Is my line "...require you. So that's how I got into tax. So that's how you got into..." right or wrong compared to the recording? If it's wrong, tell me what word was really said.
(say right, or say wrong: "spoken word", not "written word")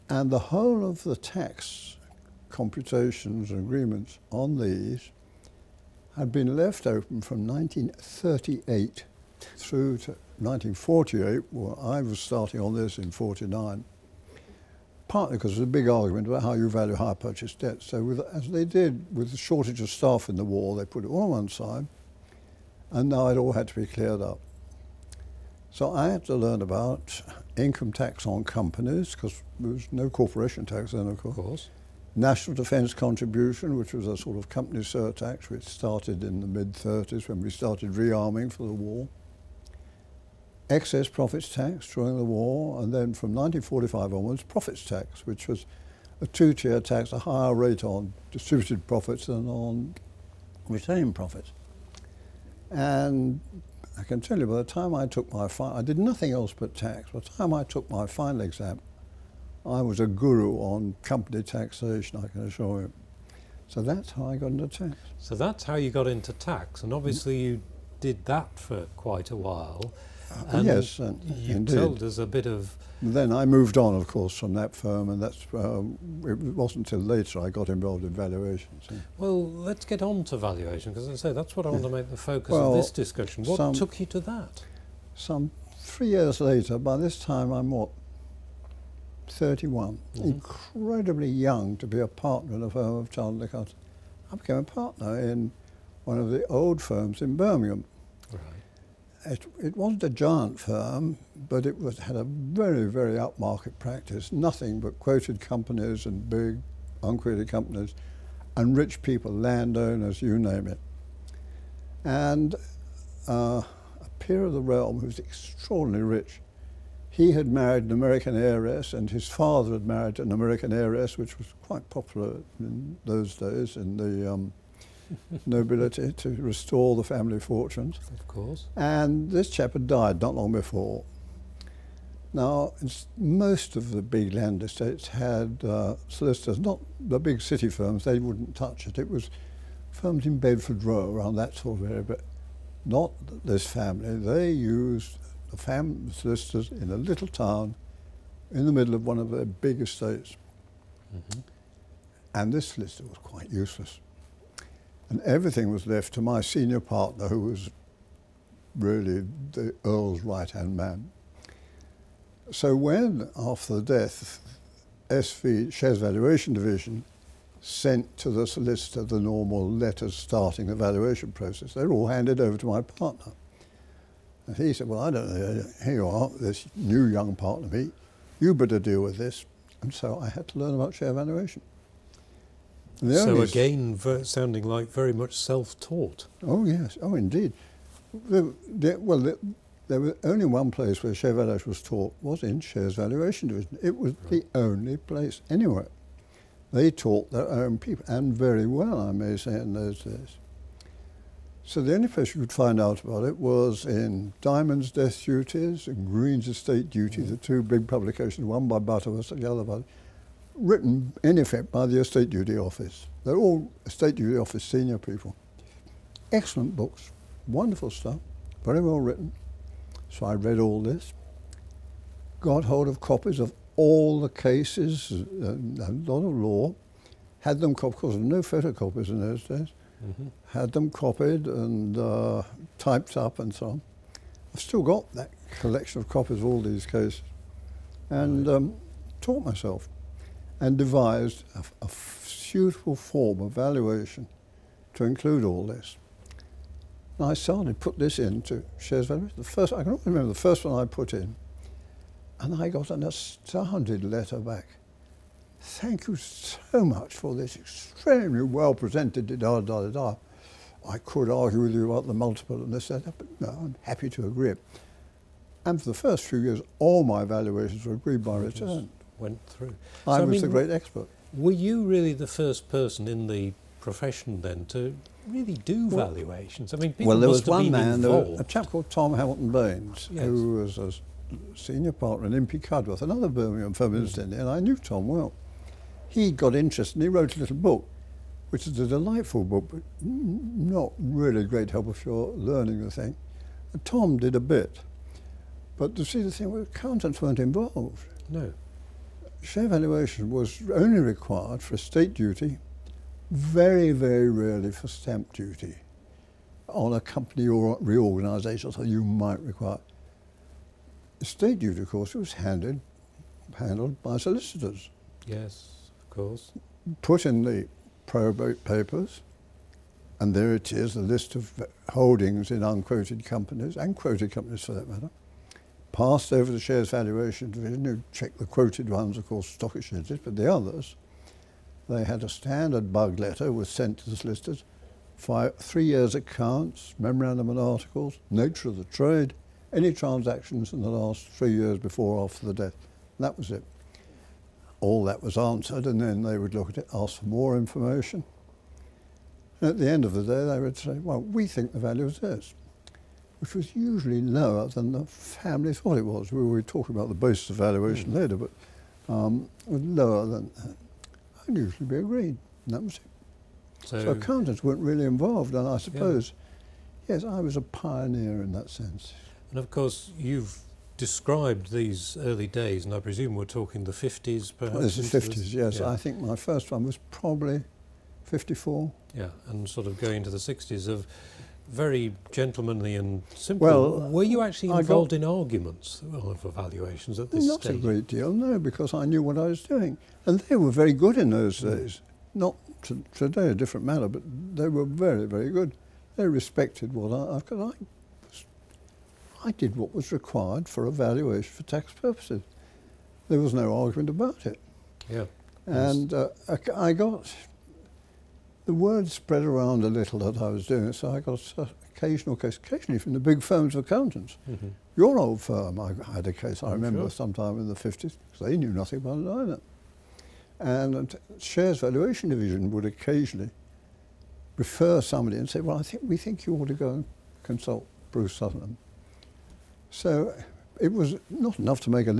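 wrong: "assure", not "require".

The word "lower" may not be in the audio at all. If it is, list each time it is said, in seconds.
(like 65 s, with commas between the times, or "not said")
354 s, 359 s.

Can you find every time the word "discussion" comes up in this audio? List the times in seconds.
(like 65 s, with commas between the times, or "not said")
82 s.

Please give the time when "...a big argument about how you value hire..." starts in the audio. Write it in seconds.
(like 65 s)
15 s.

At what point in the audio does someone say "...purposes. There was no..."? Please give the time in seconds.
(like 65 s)
401 s.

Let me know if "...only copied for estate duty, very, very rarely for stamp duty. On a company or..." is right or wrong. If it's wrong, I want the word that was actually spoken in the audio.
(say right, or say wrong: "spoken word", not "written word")
wrong: "required", not "copied".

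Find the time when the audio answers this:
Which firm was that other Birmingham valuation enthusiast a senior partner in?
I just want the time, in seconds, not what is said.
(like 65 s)
282 s.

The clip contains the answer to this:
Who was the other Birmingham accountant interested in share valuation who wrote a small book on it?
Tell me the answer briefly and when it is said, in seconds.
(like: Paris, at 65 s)
Tom Hamilton Baines, at 278 s.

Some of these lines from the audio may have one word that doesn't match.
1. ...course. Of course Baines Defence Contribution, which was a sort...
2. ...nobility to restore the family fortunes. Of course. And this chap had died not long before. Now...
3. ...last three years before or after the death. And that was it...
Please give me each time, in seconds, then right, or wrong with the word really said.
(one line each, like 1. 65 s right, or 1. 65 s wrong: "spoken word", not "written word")
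1. 31 s wrong: "National", not "Baines"
2. 125 s right
3. 340 s right.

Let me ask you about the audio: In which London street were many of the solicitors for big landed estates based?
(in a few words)
Bedford Row.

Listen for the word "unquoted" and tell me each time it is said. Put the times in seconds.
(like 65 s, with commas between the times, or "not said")
107 s, 322 s.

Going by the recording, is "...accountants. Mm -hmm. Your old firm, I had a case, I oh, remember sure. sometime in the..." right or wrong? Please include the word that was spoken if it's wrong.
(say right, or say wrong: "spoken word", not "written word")
right.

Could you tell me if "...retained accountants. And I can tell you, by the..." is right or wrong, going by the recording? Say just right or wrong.
wrong.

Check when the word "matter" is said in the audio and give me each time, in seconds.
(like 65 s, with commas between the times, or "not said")
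324 s, 393 s.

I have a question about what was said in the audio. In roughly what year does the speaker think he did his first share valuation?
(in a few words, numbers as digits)
1954.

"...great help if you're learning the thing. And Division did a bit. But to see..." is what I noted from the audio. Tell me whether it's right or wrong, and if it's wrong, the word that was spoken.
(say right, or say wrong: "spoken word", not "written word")
wrong: "Tom", not "Division".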